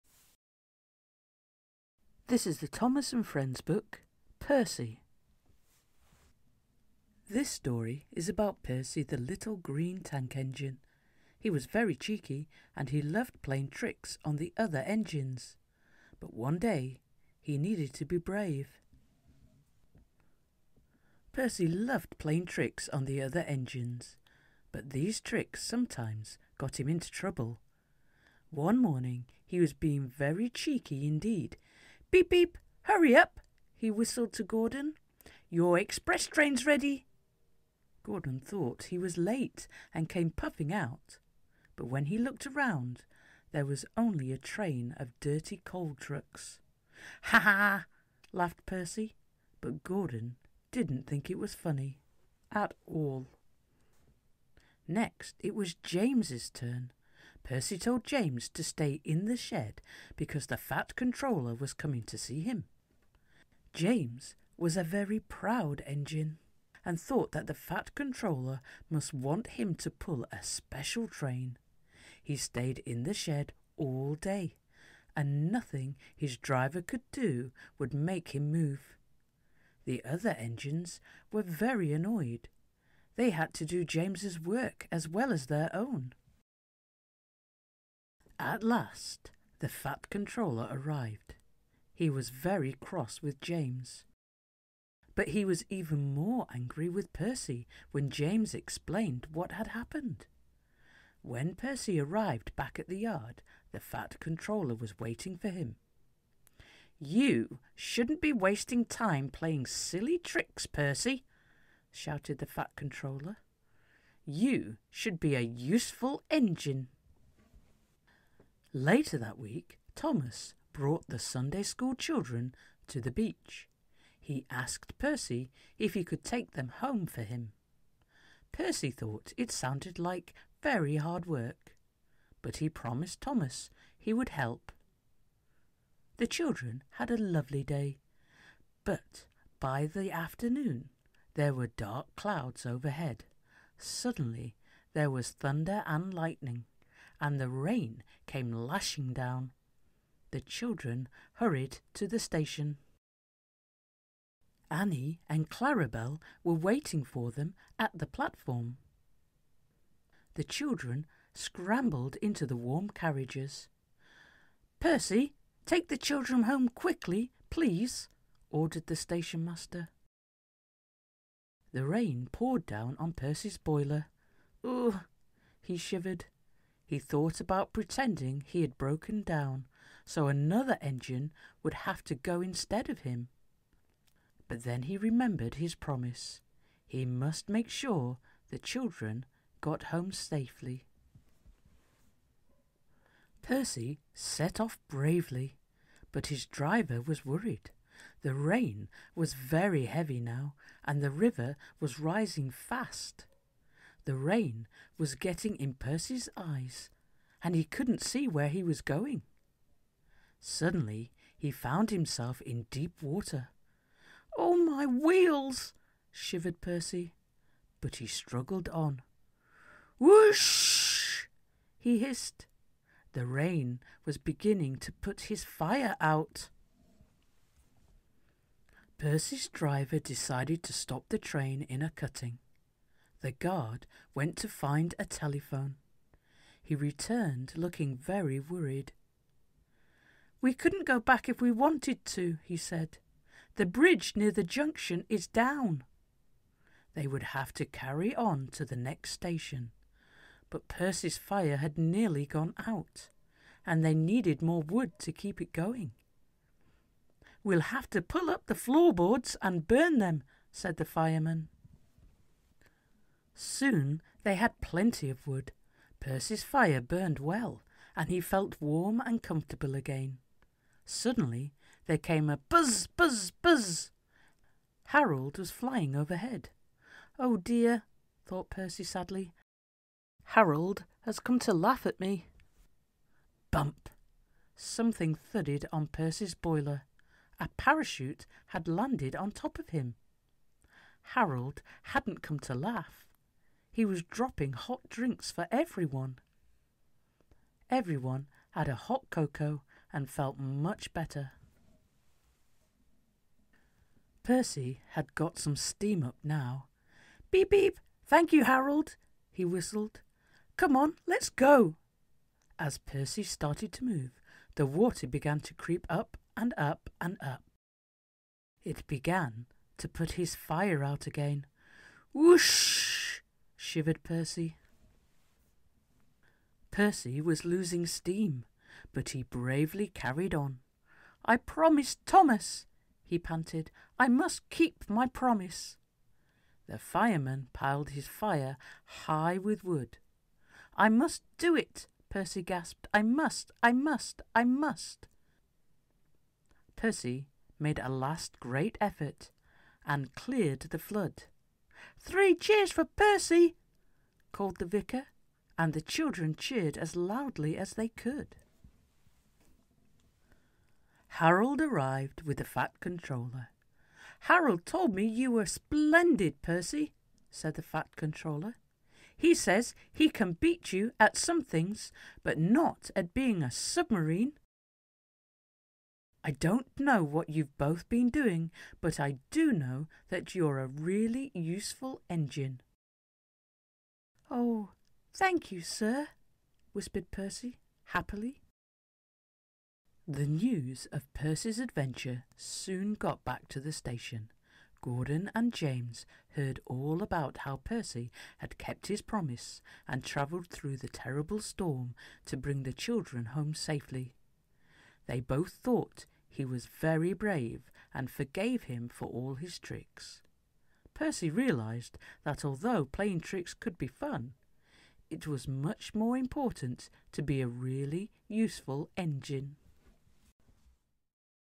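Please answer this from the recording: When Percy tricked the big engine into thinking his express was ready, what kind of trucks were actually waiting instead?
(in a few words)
dirty coal trucks.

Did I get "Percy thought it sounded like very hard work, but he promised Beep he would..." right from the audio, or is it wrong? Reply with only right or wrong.
wrong.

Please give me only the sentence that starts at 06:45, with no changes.
They both thought he was very brave and forgave him for all his tricks.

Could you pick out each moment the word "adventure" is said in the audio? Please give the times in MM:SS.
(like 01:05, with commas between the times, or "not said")
06:31.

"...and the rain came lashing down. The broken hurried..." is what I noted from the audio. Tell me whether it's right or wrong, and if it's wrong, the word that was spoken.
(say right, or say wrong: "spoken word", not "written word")
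wrong: "children", not "broken".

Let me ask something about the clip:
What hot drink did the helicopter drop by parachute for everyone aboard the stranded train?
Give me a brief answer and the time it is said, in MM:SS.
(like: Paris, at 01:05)
cocoa, at 04:59.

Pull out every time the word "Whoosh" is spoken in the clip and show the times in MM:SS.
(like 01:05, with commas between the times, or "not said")
03:39, 05:22.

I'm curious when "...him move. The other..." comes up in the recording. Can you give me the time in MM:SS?
01:18.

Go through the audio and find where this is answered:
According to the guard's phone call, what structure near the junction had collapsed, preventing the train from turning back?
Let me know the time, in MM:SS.
04:03.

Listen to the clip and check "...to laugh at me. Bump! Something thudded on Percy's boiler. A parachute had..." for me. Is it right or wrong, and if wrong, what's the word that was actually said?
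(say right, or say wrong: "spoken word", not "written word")
right.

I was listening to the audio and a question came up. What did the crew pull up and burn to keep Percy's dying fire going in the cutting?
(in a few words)
floorboards.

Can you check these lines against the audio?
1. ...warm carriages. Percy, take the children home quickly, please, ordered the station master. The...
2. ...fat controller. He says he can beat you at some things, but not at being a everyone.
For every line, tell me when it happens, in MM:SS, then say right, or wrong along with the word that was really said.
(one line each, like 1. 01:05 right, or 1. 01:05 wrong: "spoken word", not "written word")
1. 02:42 right
2. 06:07 wrong: "submarine", not "everyone".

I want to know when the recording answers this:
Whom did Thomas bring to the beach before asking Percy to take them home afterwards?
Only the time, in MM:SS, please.
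02:01.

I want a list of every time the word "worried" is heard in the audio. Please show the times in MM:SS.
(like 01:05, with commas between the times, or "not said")
03:17, 03:58.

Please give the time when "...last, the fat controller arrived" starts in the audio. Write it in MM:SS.
01:28.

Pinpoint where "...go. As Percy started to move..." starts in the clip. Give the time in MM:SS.
05:11.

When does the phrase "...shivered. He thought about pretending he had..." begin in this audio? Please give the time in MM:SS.
02:55.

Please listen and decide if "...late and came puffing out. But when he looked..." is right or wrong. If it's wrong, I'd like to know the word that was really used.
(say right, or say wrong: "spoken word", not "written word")
right.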